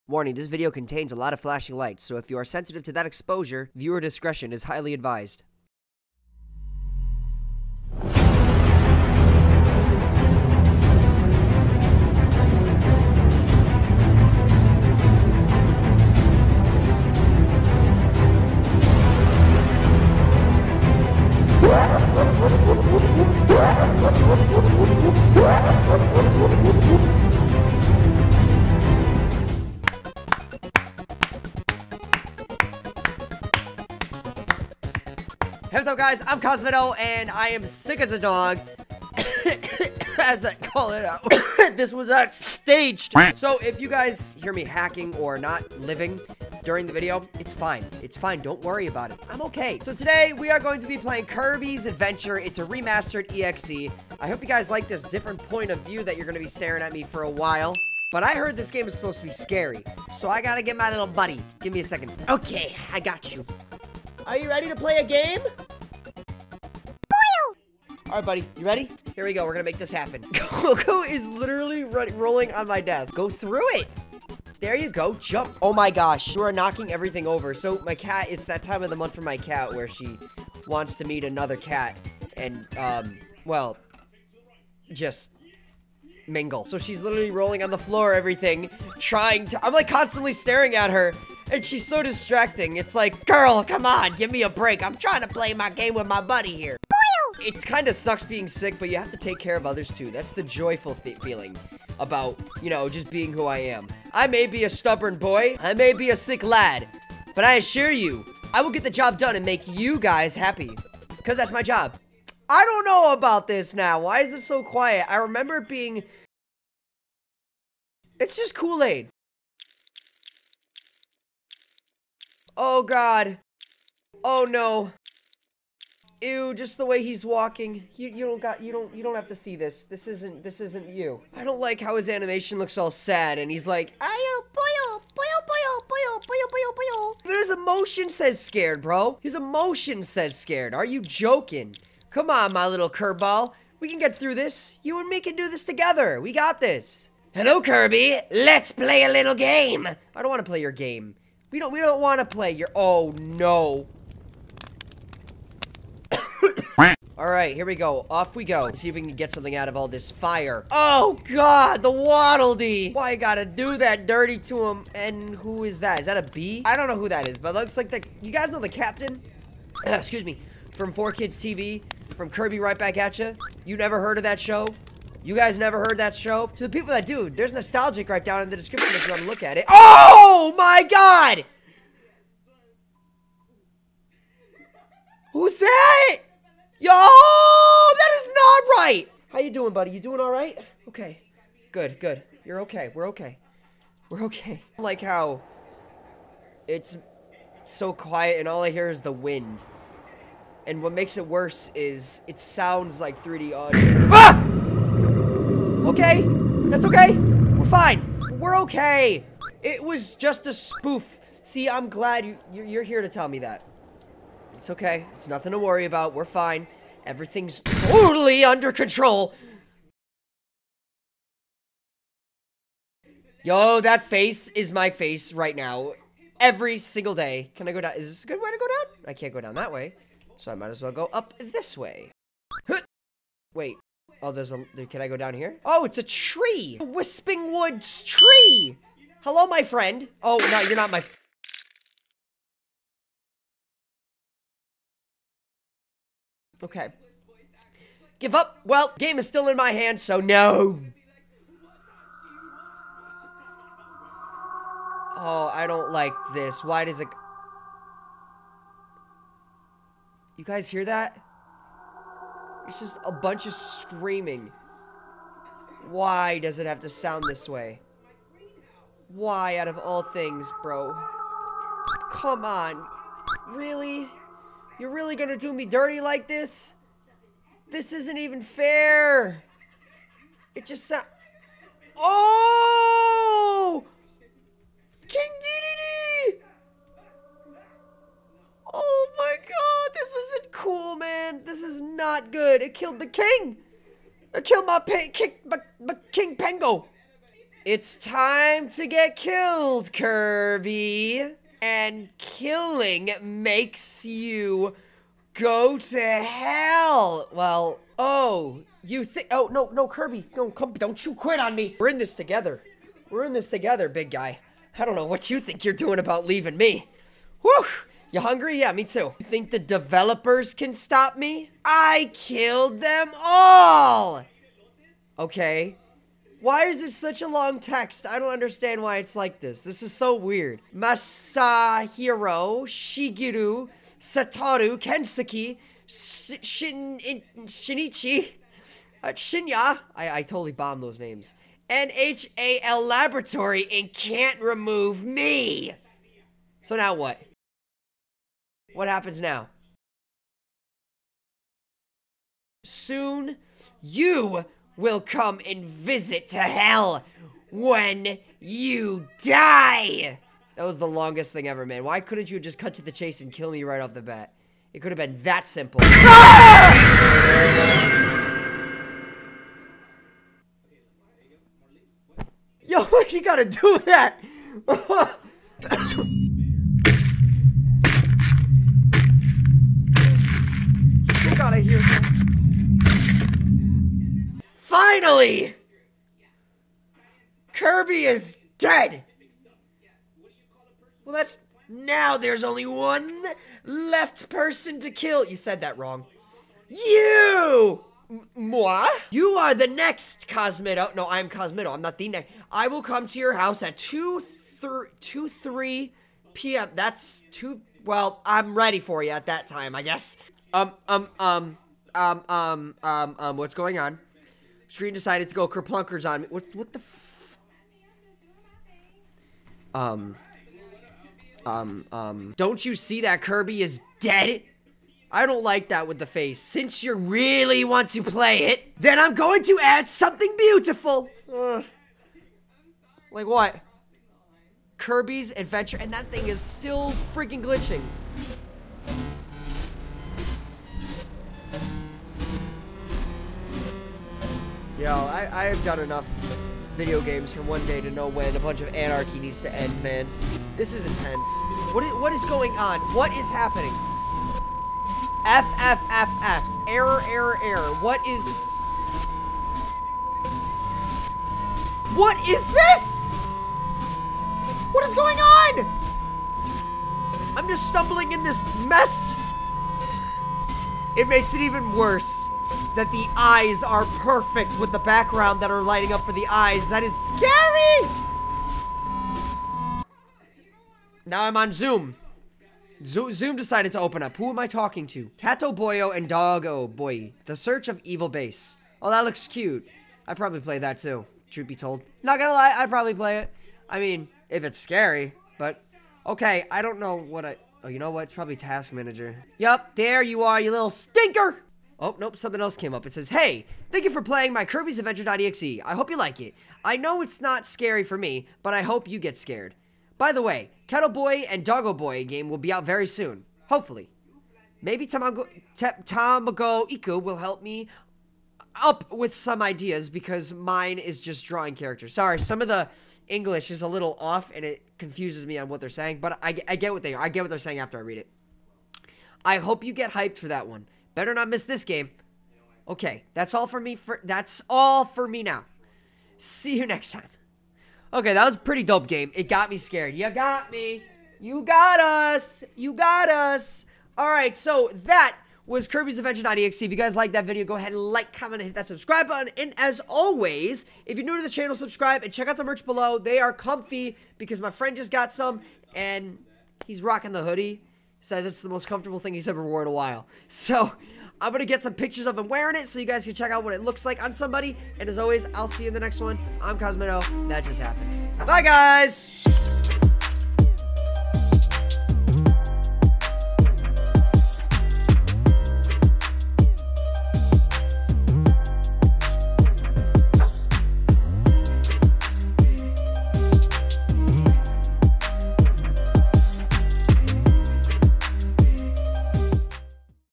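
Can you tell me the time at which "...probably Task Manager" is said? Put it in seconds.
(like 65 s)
498 s.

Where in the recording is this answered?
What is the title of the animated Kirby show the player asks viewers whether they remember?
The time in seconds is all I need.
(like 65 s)
172 s.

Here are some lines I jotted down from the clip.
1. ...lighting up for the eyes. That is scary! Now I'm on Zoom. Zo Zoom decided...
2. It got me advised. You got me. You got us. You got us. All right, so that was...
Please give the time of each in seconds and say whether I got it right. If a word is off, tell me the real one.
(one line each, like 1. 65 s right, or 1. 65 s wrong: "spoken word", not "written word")
1. 475 s right
2. 539 s wrong: "scared", not "advised".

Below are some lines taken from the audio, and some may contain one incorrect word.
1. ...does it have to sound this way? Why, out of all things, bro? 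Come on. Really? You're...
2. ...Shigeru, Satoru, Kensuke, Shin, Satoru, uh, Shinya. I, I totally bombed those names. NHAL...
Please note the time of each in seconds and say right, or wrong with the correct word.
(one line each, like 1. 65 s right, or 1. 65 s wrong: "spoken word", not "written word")
1. 266 s right
2. 332 s wrong: "Shinichi", not "Satoru".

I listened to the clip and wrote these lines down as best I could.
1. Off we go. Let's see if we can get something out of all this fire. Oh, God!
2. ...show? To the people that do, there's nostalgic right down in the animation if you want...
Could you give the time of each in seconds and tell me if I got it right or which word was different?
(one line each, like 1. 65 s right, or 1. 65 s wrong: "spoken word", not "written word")
1. 158 s right
2. 176 s wrong: "description", not "animation".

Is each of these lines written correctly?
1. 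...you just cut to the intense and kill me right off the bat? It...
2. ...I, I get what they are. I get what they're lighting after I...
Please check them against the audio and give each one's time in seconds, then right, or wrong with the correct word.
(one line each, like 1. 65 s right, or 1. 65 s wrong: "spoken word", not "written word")
1. 362 s wrong: "chase", not "intense"
2. 526 s wrong: "saying", not "lighting".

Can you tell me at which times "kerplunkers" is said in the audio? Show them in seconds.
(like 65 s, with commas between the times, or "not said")
415 s.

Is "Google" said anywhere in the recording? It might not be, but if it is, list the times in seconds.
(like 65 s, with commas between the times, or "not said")
not said.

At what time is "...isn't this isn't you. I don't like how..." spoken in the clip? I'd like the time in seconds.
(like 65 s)
130 s.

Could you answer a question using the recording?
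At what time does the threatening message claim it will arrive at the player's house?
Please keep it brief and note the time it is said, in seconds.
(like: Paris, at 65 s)
2:03 p.m., at 405 s.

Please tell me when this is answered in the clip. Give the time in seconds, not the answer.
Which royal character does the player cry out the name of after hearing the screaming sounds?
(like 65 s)
285 s.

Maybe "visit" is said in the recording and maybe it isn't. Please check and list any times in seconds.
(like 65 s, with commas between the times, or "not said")
355 s.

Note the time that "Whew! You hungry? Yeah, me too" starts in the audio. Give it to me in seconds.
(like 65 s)
317 s.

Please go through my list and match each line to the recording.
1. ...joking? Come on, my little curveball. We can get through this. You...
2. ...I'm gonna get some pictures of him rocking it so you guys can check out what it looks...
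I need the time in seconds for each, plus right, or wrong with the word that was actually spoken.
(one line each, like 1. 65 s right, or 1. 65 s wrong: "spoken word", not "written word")
1. 141 s right
2. 561 s wrong: "wearing", not "rocking".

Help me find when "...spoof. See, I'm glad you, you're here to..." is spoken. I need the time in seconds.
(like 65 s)
210 s.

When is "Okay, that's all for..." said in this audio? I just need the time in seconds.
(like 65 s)
532 s.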